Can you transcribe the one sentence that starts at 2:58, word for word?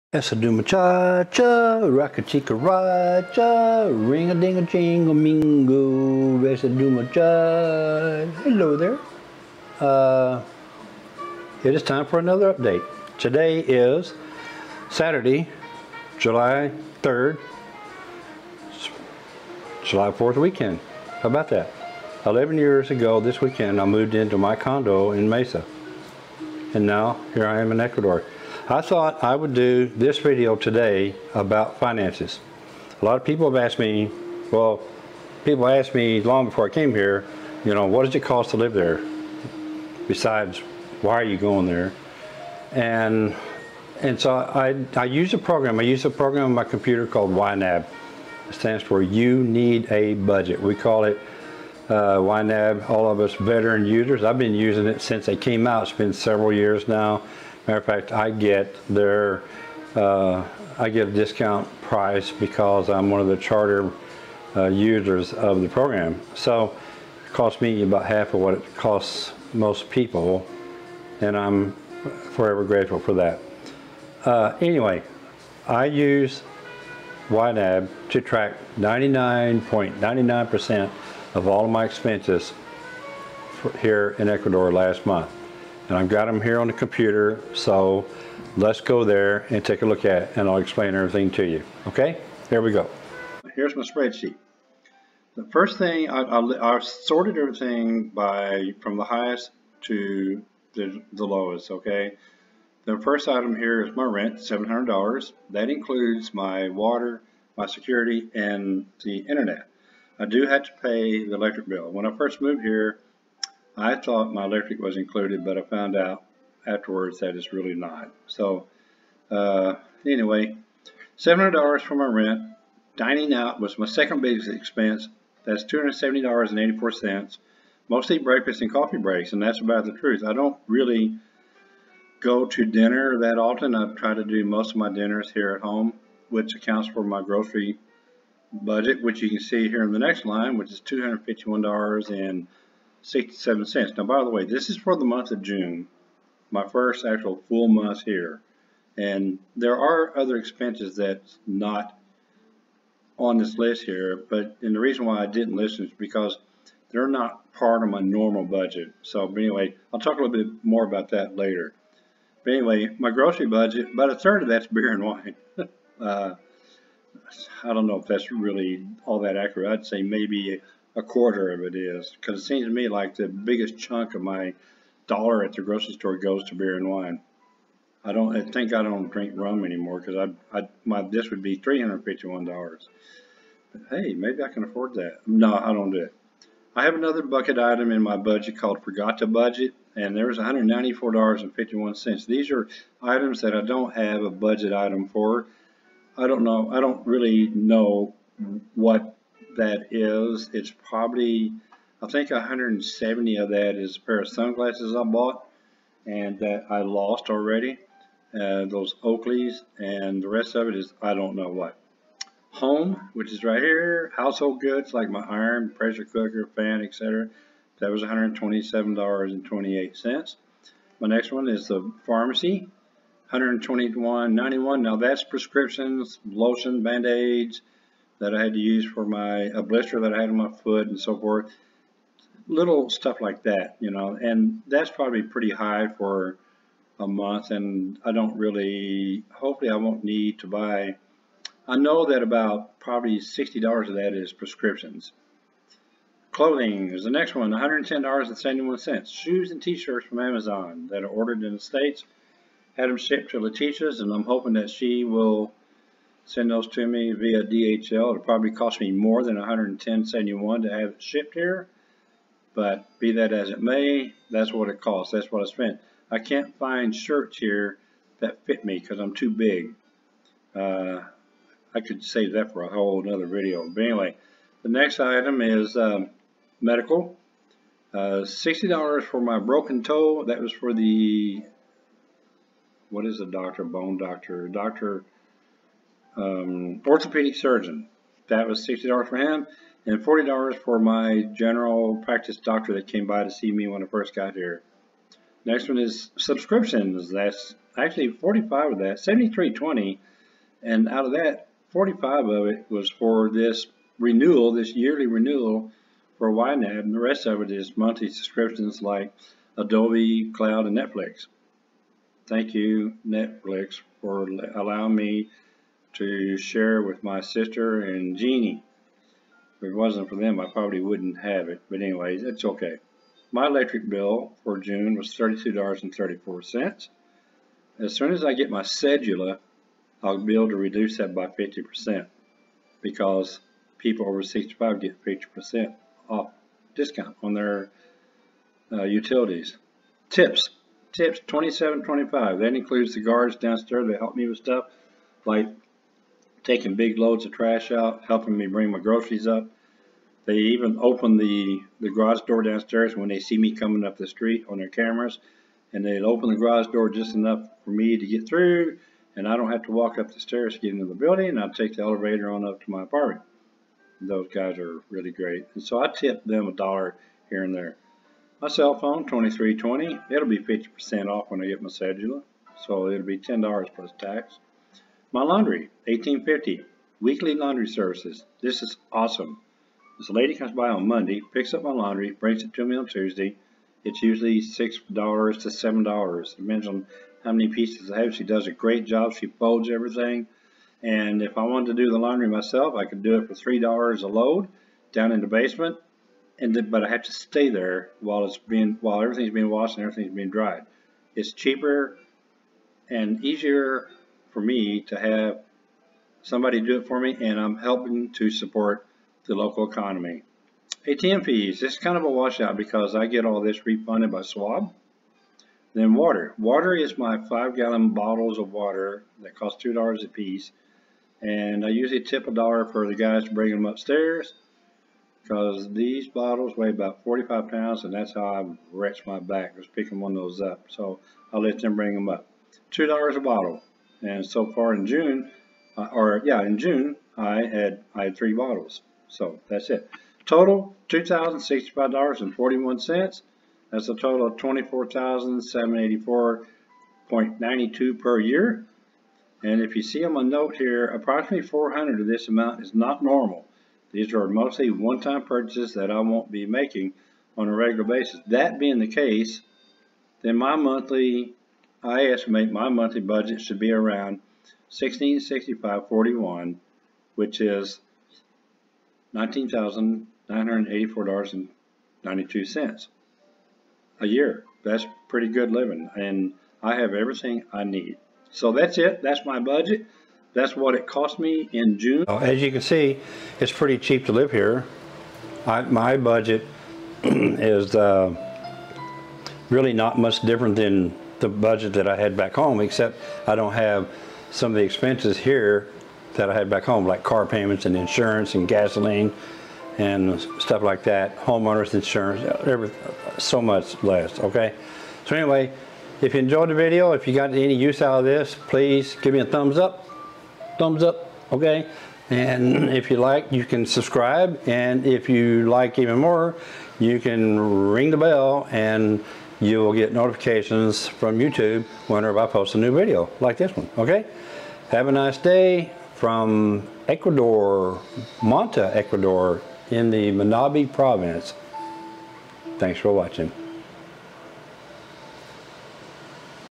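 I don't I think I don't drink rum anymore because I, I my this would be three hundred fifty one dollars.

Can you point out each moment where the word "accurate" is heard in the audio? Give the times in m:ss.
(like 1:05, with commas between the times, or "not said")
2:49.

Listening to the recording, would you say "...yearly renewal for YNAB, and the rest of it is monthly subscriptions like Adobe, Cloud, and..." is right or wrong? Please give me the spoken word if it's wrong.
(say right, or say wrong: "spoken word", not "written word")
right.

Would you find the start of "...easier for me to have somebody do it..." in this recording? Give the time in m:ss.
6:43.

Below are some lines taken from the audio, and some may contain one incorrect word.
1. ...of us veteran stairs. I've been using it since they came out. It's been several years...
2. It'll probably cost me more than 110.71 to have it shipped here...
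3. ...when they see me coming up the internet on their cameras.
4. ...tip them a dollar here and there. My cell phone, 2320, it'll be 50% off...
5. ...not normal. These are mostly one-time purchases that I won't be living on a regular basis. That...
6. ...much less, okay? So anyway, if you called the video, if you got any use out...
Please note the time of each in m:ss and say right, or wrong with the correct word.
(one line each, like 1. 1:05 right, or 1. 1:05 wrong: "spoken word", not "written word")
1. 0:53 wrong: "users", not "stairs"
2. 4:17 right
3. 5:52 wrong: "street", not "internet"
4. 6:05 right
5. 7:32 wrong: "making", not "living"
6. 8:23 wrong: "enjoyed", not "called".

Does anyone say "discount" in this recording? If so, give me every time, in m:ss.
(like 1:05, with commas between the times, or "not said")
1:01, 5:36.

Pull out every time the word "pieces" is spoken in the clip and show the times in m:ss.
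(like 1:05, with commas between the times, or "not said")
6:27, 7:00.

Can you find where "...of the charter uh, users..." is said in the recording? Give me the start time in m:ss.
1:03.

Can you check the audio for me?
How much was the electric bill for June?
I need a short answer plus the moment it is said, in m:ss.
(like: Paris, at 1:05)
$32.34, at 5:25.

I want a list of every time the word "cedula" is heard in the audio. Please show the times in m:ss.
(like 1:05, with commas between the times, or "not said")
5:28, 6:11.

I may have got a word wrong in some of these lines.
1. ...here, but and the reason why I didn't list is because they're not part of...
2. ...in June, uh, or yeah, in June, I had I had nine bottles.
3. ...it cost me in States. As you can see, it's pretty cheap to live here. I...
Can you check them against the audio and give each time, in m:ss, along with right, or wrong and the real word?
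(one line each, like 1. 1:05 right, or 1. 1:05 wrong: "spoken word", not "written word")
1. 2:33 right
2. 7:14 wrong: "three", not "nine"
3. 8:00 wrong: "June", not "States".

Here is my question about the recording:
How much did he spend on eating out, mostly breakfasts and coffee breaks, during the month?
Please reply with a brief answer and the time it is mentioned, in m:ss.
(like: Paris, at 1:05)
$270.84, at 2:05.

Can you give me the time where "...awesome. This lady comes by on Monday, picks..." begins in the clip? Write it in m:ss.
6:18.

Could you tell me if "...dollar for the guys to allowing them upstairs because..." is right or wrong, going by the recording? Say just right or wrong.
wrong.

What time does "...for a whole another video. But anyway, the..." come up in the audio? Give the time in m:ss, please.
4:32.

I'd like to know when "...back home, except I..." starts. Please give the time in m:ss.
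8:12.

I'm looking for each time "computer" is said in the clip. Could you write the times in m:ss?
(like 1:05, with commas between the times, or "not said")
0:46, 1:26.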